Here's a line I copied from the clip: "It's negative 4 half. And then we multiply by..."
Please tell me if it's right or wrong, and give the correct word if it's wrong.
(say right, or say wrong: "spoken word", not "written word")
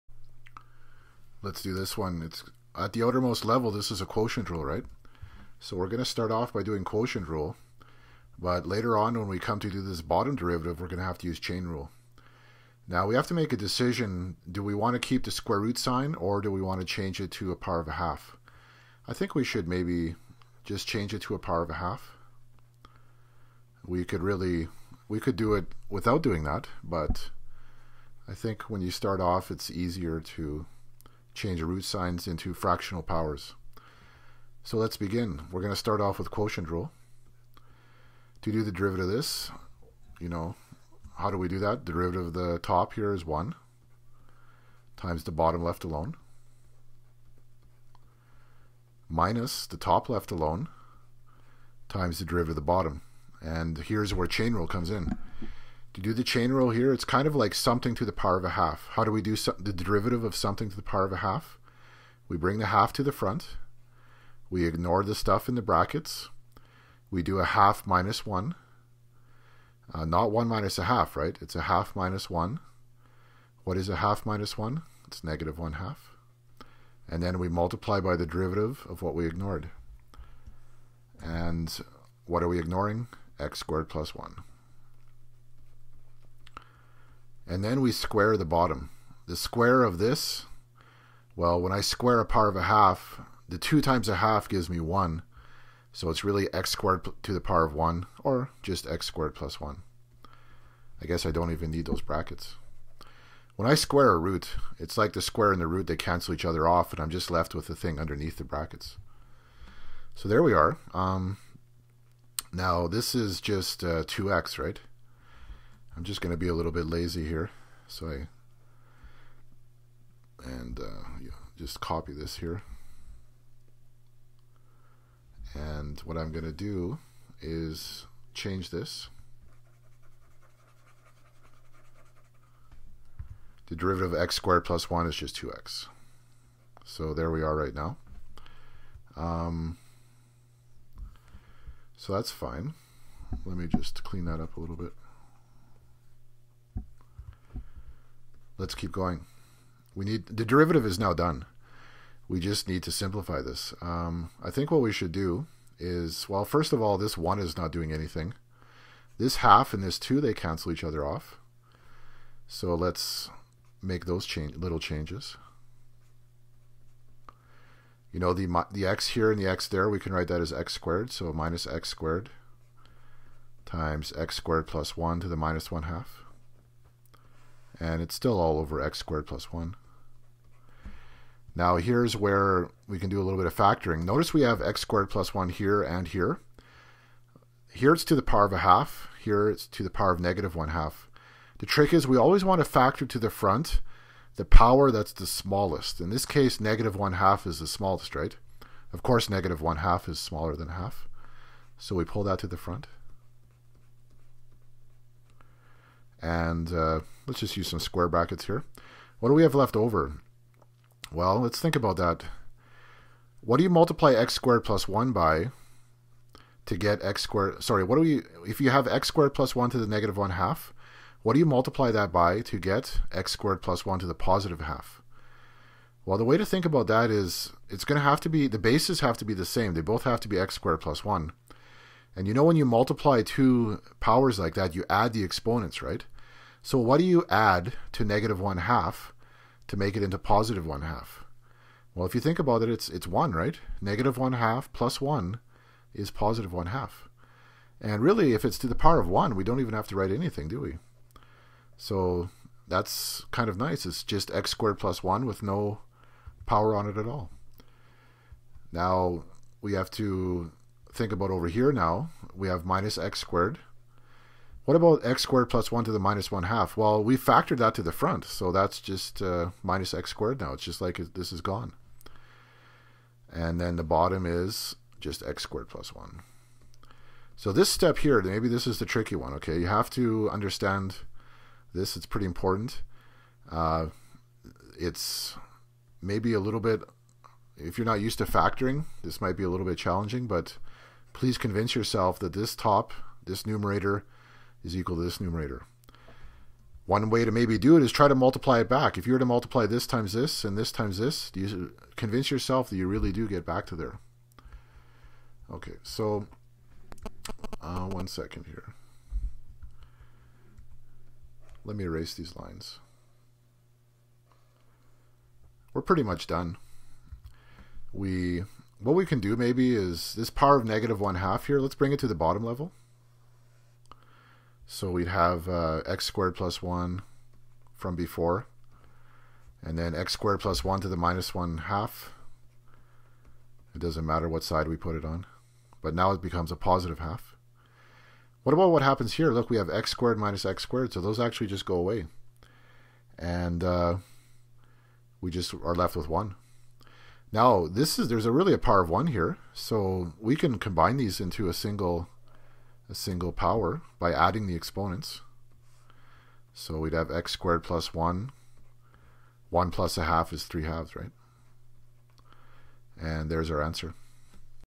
wrong: "1", not "4".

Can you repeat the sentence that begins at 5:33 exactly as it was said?
It doesn't matter what side we put it on, but now it becomes a positive half.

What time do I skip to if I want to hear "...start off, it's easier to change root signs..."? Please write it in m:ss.
0:28.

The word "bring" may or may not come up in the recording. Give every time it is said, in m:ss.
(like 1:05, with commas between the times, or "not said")
1:02, 5:21.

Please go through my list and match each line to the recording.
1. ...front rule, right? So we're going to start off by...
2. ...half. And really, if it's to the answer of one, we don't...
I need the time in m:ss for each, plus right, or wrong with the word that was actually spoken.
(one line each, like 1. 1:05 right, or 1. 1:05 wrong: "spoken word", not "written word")
1. 0:04 wrong: "quotient", not "front"
2. 4:06 wrong: "power", not "answer".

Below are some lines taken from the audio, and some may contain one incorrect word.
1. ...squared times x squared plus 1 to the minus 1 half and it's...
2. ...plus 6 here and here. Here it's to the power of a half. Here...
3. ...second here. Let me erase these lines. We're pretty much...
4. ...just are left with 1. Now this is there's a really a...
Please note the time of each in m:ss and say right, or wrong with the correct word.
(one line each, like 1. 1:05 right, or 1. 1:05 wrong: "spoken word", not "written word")
1. 2:51 right
2. 3:05 wrong: "1", not "6"
3. 5:08 right
4. 5:45 right.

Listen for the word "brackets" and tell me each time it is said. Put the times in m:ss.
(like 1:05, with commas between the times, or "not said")
1:05, 1:41, 1:48, 3:28.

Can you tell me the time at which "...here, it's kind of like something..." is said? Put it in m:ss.
0:56.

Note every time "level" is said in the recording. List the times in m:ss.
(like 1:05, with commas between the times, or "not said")
0:03, 5:22.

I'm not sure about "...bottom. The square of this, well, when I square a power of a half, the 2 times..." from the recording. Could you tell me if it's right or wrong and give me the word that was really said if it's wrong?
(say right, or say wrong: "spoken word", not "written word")
right.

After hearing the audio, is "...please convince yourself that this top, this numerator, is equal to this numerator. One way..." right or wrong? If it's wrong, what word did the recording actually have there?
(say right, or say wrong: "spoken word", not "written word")
right.